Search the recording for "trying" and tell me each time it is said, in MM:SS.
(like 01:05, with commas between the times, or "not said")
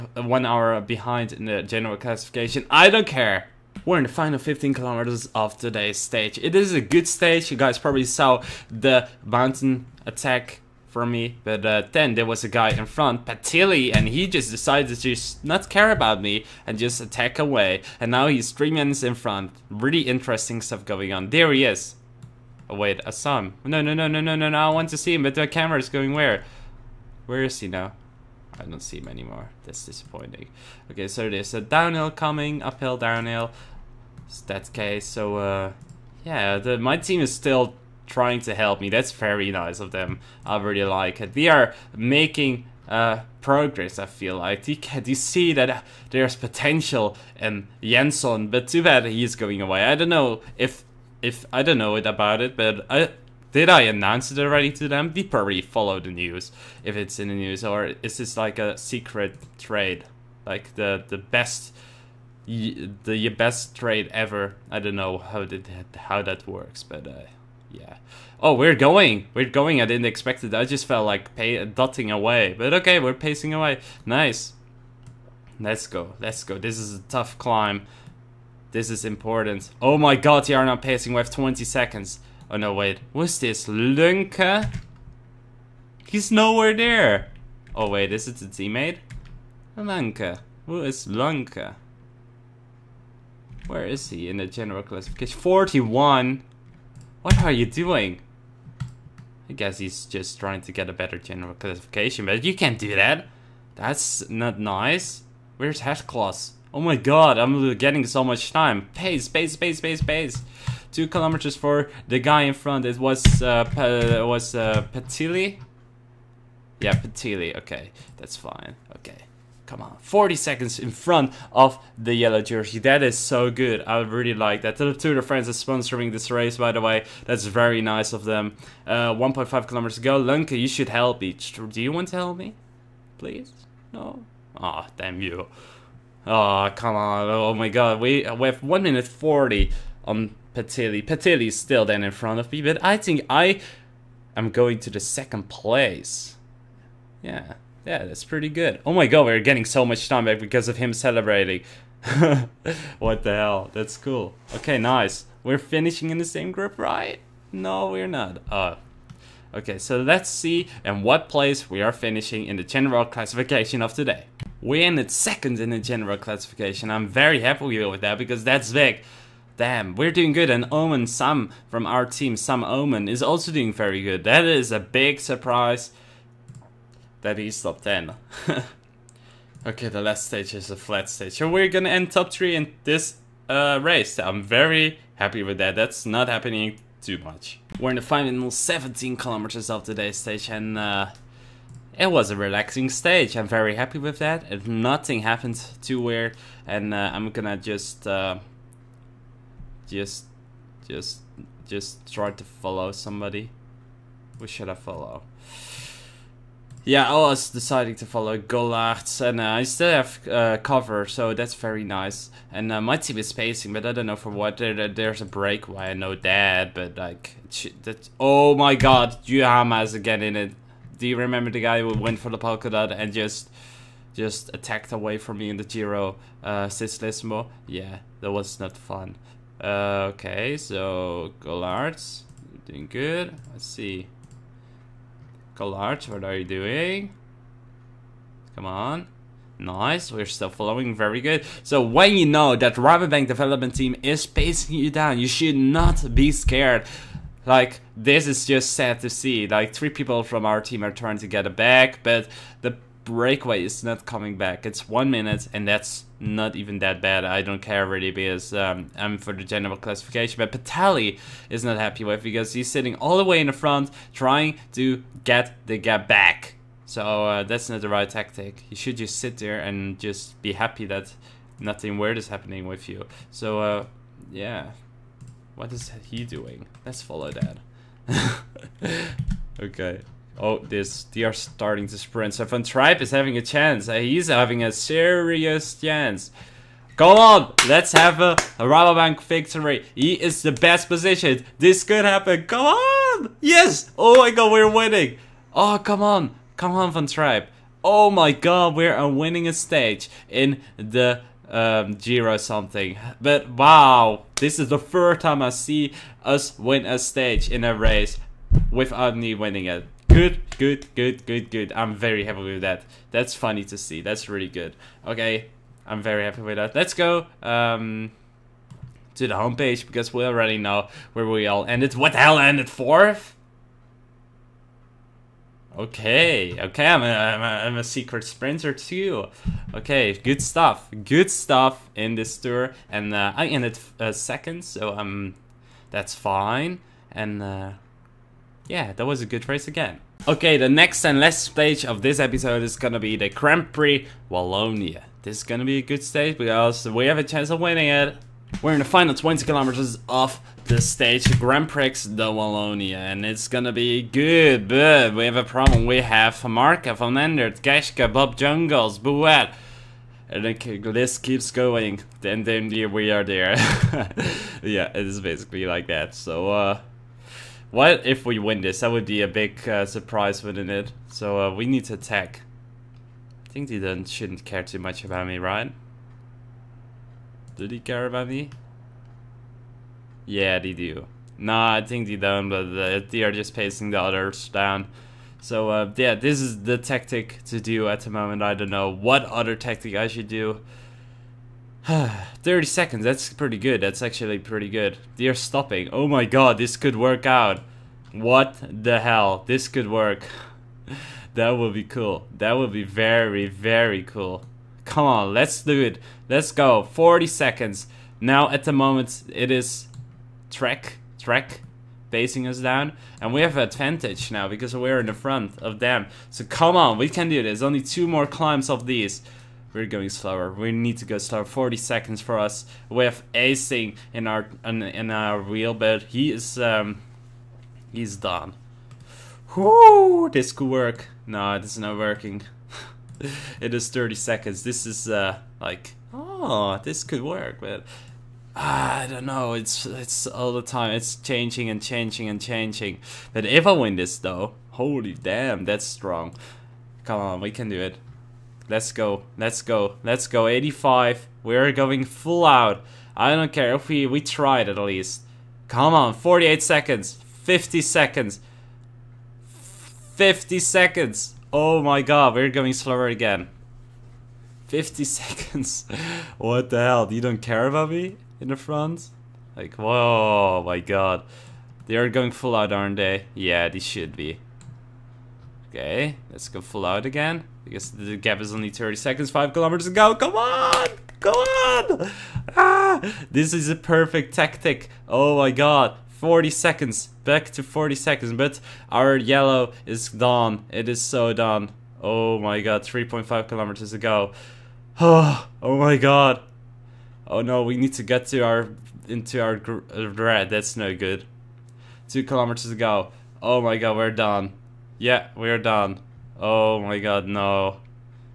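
00:38, 01:40, 04:10, 04:24.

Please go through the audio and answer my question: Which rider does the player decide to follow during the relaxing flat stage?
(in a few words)
Gollards.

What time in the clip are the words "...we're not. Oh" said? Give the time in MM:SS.
02:37.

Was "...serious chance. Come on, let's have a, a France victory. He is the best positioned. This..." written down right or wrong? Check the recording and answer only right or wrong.
wrong.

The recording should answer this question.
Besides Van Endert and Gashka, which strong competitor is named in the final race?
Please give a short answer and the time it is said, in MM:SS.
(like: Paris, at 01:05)
Bob Jungels, at 05:58.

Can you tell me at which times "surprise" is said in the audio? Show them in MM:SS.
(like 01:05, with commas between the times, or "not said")
02:55, 06:09.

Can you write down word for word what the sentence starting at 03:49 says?
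Uh, okay, so Collards, doing good.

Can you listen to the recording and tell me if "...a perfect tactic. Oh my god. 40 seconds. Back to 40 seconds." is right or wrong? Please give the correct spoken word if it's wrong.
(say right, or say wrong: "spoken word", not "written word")
right.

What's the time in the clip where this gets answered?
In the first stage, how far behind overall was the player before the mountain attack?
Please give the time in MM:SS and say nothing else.
00:00.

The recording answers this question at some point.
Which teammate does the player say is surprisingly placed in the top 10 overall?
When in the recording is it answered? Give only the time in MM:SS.
02:52.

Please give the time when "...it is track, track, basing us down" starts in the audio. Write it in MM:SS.
06:49.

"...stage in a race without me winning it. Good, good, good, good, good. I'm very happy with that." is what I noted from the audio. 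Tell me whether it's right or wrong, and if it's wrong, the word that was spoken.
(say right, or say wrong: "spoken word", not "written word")
right.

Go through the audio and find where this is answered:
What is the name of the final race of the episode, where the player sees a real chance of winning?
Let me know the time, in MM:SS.
05:43.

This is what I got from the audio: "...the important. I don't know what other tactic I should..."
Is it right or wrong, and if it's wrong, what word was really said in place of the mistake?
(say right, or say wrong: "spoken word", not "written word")
wrong: "moment", not "important".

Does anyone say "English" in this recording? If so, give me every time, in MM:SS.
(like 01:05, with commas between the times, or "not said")
not said.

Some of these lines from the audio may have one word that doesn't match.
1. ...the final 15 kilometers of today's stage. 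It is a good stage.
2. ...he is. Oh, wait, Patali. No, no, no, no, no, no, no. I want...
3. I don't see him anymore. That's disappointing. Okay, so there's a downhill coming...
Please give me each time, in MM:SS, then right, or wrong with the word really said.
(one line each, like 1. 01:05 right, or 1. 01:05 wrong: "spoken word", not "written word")
1. 00:04 right
2. 00:21 wrong: "Assam", not "Patali"
3. 00:28 right.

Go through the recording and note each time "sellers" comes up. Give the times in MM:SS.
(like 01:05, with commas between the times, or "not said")
not said.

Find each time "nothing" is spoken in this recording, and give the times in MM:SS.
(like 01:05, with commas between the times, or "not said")
03:14, 04:31.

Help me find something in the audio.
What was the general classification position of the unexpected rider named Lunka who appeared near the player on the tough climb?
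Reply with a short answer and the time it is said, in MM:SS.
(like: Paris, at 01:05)
41, at 01:35.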